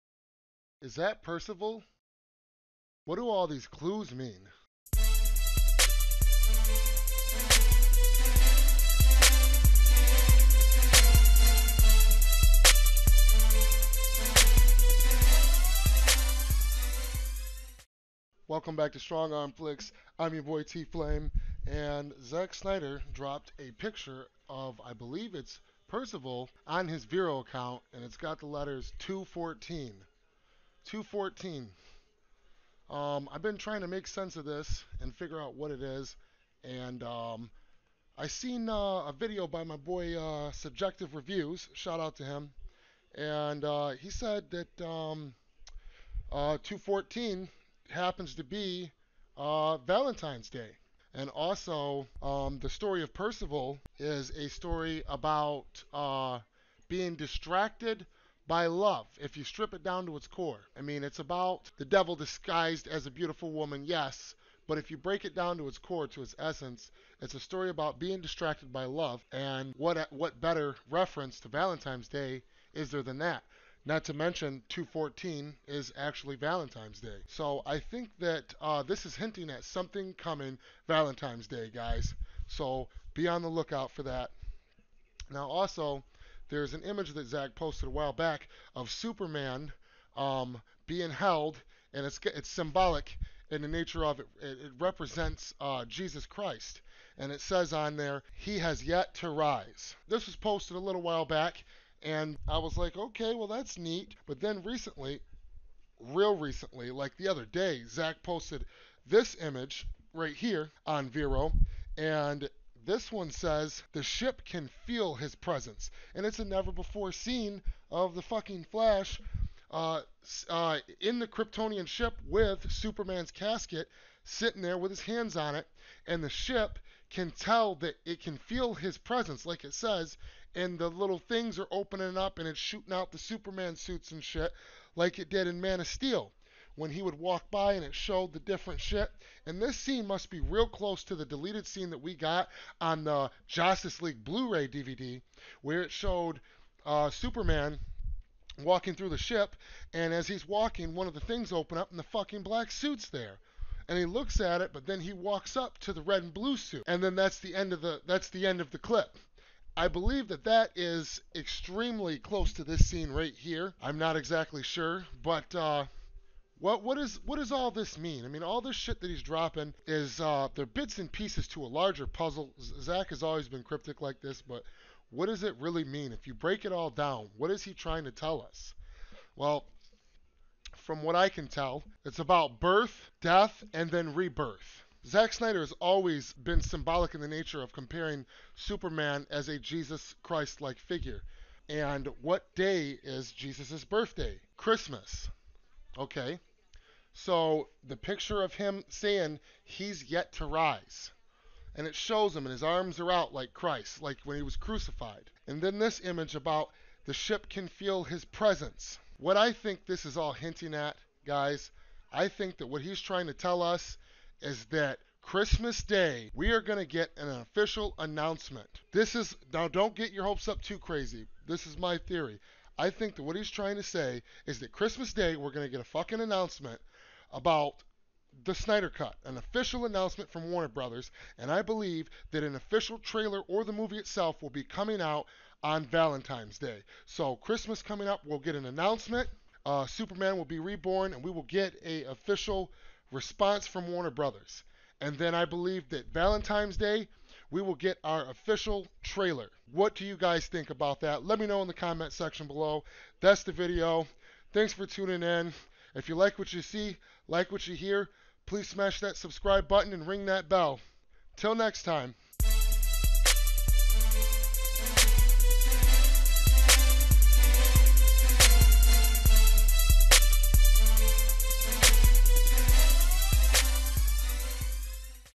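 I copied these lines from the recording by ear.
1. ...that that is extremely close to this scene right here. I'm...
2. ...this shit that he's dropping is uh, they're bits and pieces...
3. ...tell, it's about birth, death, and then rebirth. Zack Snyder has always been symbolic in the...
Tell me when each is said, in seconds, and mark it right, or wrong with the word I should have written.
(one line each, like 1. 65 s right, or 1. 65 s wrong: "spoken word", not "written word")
1. 160 s right
2. 168 s right
3. 181 s right.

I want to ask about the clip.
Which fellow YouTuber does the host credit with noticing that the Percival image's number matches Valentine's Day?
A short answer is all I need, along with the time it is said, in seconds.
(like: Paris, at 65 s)
Subjective Reviews, at 40 s.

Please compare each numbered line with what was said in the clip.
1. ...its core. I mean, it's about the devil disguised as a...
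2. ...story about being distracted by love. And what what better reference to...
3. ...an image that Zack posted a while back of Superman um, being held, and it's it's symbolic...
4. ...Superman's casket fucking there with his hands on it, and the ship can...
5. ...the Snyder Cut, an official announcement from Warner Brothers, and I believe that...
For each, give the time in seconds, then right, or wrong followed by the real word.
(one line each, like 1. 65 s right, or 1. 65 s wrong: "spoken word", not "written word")
1. 60 s right
2. 67 s right
3. 86 s right
4. 122 s wrong: "sitting", not "fucking"
5. 228 s right.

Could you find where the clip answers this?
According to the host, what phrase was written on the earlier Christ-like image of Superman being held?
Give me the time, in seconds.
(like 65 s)
98 s.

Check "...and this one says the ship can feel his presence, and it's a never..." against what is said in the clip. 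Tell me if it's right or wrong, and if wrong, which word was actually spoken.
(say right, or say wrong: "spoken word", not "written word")
right.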